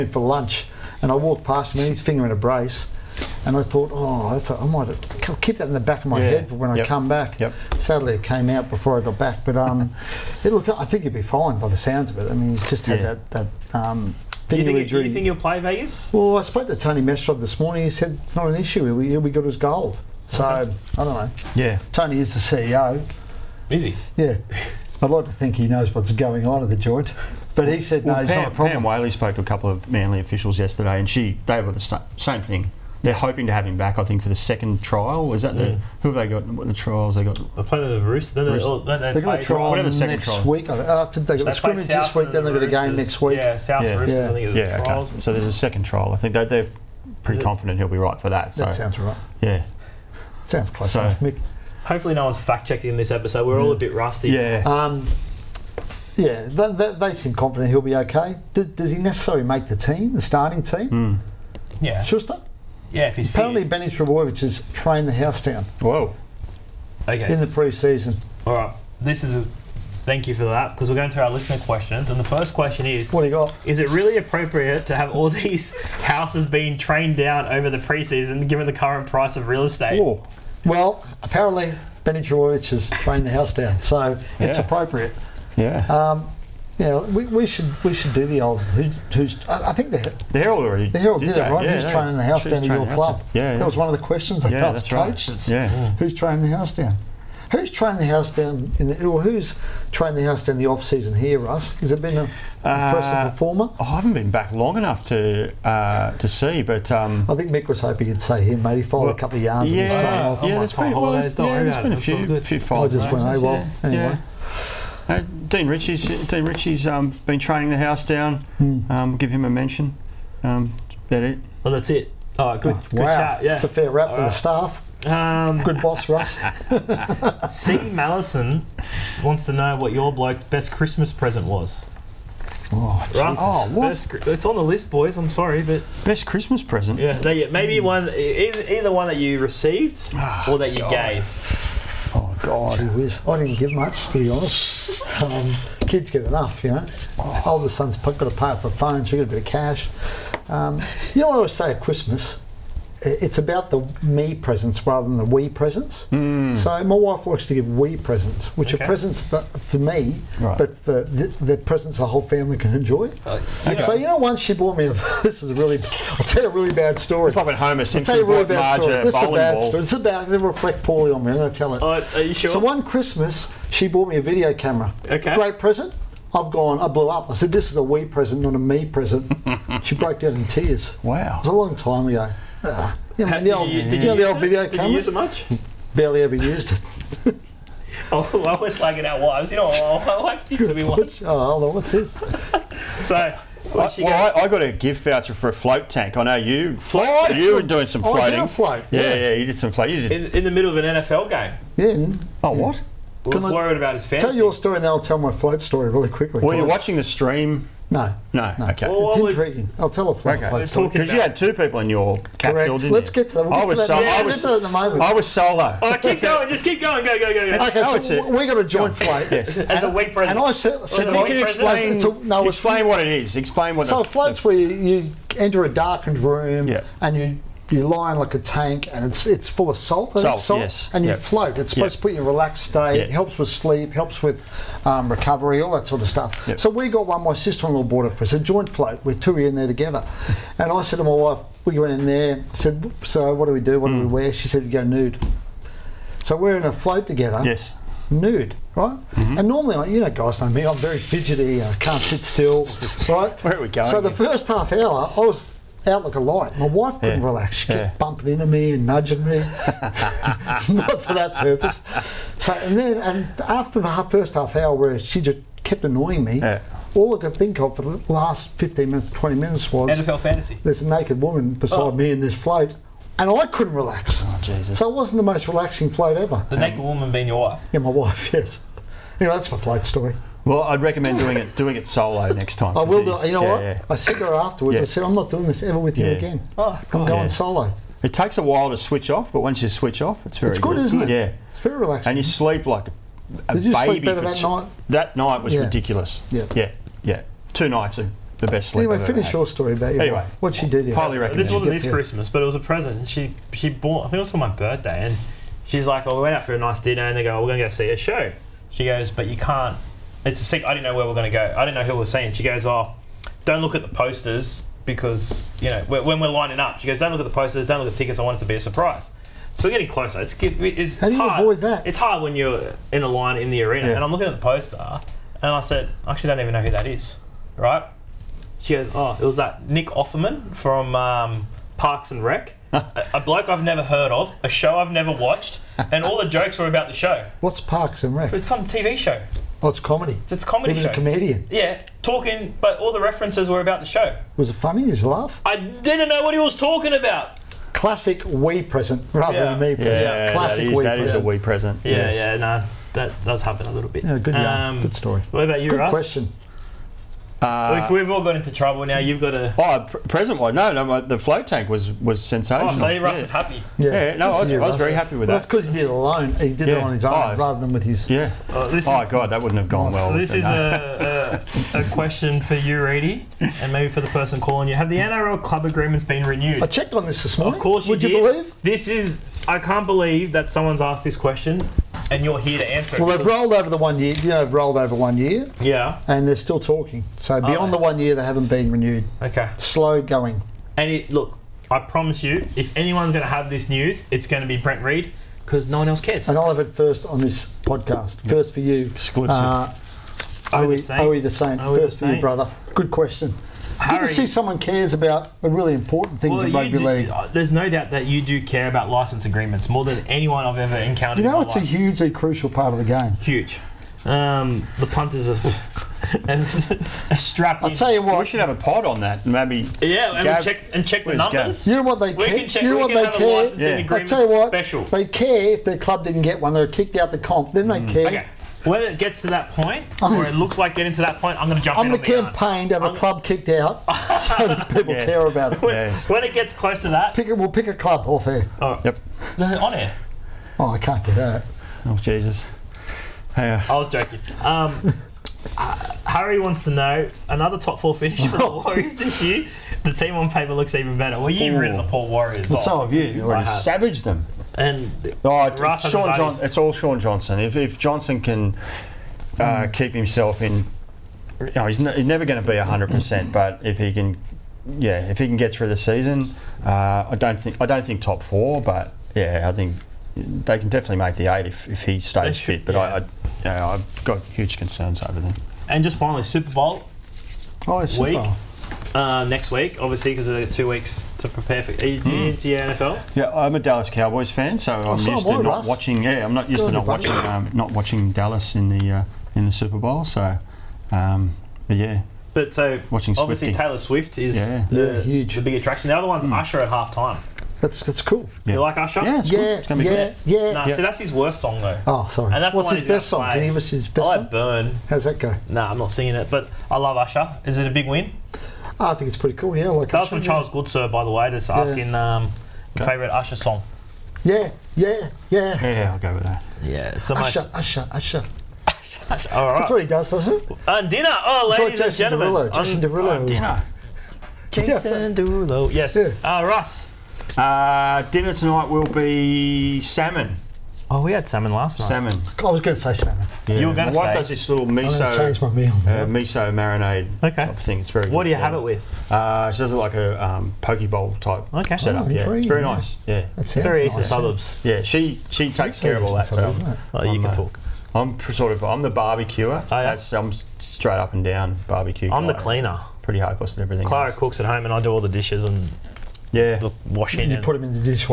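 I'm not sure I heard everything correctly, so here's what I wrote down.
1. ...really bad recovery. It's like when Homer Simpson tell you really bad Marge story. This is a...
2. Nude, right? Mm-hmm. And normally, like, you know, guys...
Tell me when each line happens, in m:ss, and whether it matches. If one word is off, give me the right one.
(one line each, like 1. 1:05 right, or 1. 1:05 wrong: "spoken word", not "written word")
1. 2:46 wrong: "story", not "recovery"
2. 4:08 right.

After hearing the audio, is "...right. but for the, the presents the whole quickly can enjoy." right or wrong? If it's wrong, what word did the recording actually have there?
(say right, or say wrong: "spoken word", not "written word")
wrong: "family", not "quickly".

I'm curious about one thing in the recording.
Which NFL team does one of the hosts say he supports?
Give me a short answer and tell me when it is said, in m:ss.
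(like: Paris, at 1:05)
Dallas Cowboys, at 8:03.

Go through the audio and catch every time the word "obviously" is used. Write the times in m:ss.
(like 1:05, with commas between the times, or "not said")
7:59, 8:13.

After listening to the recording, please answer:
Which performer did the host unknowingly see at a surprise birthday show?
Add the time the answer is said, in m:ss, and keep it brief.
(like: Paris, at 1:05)
Nick Offerman, at 5:29.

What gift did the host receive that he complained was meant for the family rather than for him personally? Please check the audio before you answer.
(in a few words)
A video camera.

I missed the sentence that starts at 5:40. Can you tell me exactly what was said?
So it's a comedy he was show.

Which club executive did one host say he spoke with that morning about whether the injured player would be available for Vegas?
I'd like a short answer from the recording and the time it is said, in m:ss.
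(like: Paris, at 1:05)
Tony Mestrov, at 0:16.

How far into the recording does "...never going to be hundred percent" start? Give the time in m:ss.
7:42.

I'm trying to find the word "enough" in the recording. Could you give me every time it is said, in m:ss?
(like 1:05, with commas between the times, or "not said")
1:44, 2:26.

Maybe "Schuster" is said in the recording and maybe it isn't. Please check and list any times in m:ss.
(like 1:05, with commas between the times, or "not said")
1:02.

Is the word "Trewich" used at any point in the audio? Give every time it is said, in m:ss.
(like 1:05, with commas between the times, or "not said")
1:22.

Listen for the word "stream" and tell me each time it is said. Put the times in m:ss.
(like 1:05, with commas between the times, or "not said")
3:27.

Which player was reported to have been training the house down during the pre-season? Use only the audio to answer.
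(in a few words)
Benny Trbojevic.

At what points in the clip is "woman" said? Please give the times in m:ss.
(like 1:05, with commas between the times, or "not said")
4:31, 4:36.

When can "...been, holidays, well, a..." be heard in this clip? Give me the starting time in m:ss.
1:50.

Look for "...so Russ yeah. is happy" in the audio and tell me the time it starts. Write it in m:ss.
6:02.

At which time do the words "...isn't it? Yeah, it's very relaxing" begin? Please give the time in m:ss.
4:50.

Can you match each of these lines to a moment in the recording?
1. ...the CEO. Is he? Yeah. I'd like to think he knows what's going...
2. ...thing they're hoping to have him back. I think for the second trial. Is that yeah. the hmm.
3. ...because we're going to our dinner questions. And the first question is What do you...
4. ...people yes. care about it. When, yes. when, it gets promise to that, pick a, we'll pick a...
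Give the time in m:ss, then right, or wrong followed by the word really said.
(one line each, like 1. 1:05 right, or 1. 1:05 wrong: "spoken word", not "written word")
1. 0:22 right
2. 0:32 right
3. 1:10 wrong: "listener", not "dinner"
4. 7:14 wrong: "close", not "promise".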